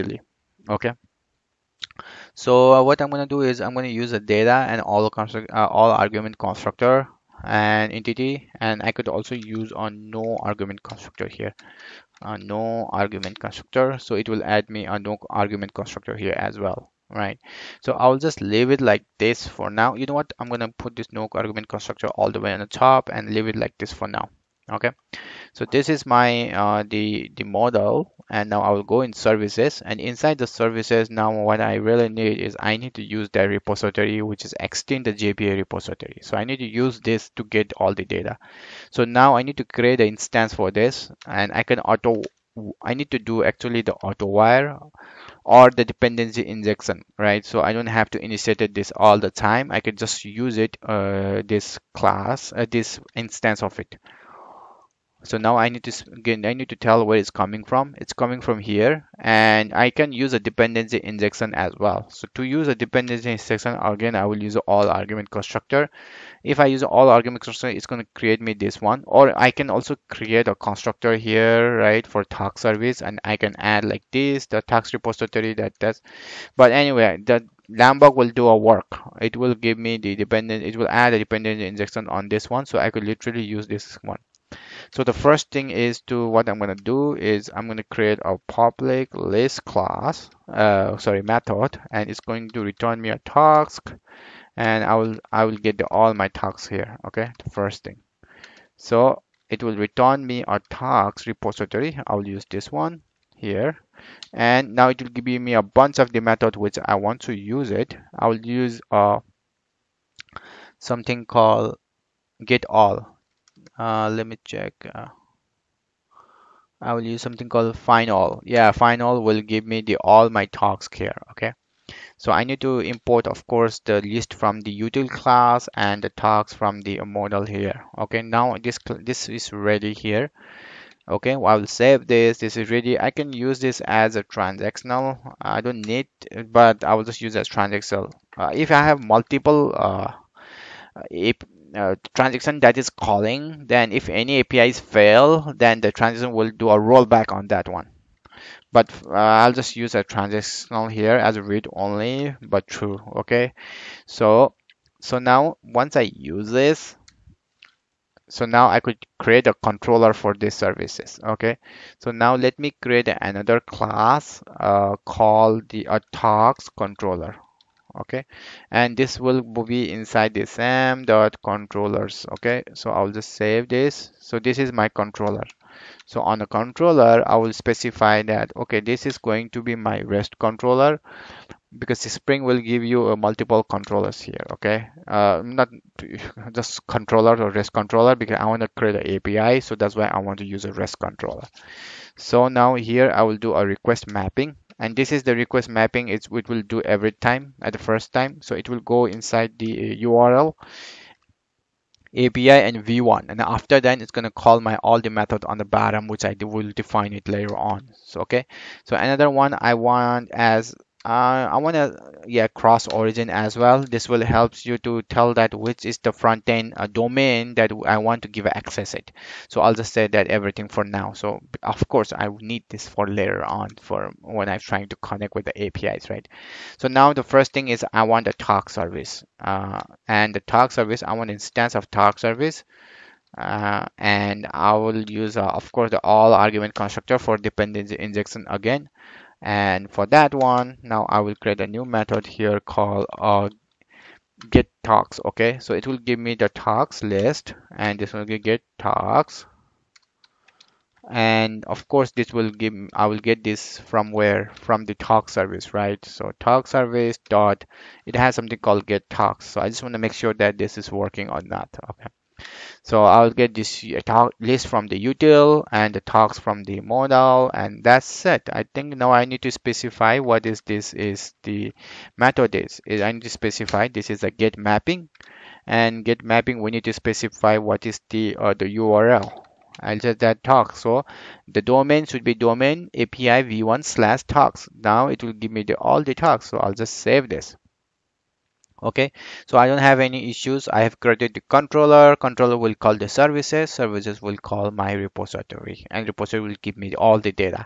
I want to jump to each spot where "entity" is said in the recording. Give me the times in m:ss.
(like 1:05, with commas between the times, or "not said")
0:07.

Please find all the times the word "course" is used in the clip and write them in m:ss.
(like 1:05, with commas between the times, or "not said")
2:03, 3:41, 3:55, 4:11.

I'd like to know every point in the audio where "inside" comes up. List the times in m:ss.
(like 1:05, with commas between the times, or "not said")
0:30, 2:49, 3:19.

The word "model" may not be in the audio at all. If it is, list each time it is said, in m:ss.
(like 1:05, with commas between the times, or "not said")
0:27, 2:07.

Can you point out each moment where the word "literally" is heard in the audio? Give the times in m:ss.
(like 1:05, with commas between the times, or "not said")
1:23.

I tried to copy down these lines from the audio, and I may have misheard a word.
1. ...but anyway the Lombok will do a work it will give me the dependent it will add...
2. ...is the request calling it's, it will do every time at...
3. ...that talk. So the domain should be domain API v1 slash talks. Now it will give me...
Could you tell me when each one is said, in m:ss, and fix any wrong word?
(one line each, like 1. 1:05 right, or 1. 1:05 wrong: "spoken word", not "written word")
1. 1:16 right
2. 3:15 wrong: "mapping", not "calling"
3. 4:40 right.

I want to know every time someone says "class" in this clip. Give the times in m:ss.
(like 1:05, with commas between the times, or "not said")
0:51, 1:29, 2:05, 2:43.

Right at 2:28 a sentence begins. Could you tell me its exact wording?
But uh, I'll just use a transactional here as read only, but true.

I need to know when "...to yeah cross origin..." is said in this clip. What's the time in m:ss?
3:31.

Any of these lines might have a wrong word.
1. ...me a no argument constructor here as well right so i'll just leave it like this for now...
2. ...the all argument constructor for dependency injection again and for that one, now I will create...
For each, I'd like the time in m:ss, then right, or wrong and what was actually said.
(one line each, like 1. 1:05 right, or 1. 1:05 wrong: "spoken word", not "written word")
1. 0:14 right
2. 3:55 right.